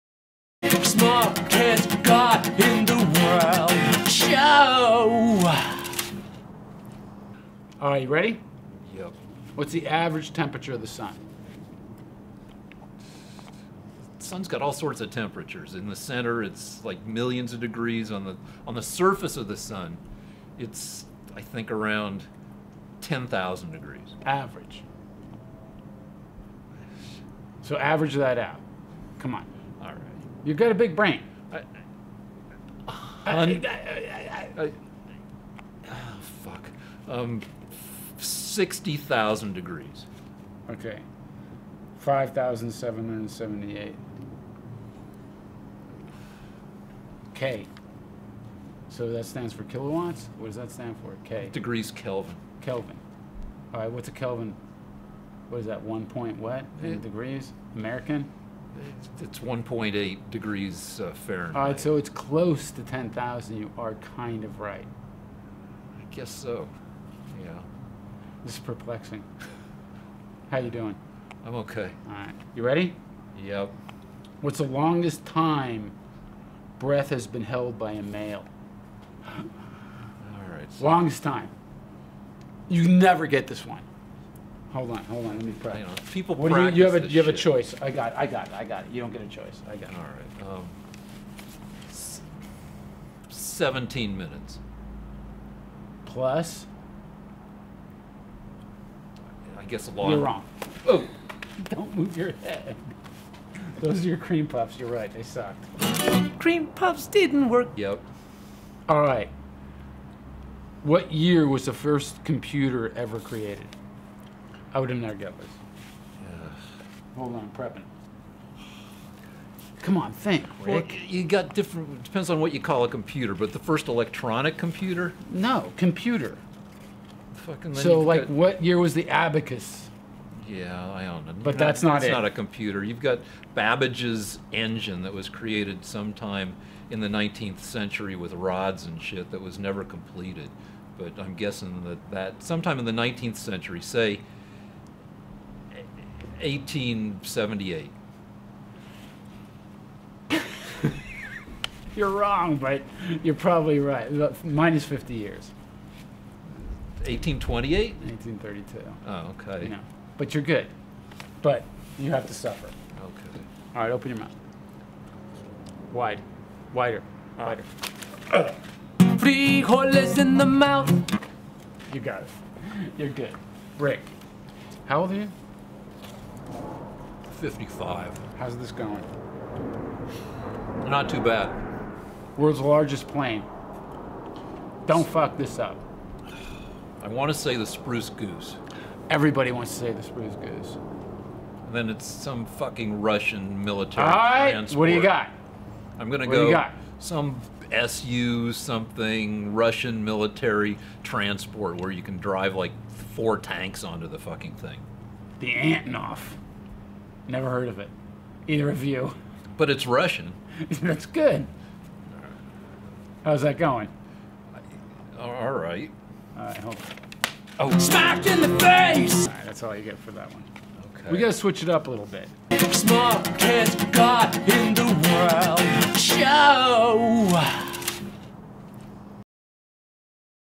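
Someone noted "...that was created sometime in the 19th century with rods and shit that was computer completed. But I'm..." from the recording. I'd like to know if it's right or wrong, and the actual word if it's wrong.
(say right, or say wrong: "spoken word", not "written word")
wrong: "never", not "computer".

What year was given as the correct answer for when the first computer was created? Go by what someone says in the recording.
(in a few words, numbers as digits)
1832.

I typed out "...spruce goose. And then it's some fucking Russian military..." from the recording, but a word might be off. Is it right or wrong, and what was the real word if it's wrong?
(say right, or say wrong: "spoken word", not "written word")
right.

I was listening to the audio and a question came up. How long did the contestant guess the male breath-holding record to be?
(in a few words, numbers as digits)
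17 minutes.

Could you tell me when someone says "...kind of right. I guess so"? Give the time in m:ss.
1:04.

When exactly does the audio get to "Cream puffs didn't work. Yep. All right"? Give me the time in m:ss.
1:46.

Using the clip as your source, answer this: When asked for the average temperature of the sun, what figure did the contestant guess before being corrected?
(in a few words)
60,000 degrees.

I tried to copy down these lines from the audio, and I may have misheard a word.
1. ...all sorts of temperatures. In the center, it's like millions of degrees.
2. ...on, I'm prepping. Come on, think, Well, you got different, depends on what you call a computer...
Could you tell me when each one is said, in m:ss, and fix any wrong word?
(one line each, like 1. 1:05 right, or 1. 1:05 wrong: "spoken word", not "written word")
1. 0:14 right
2. 1:57 right.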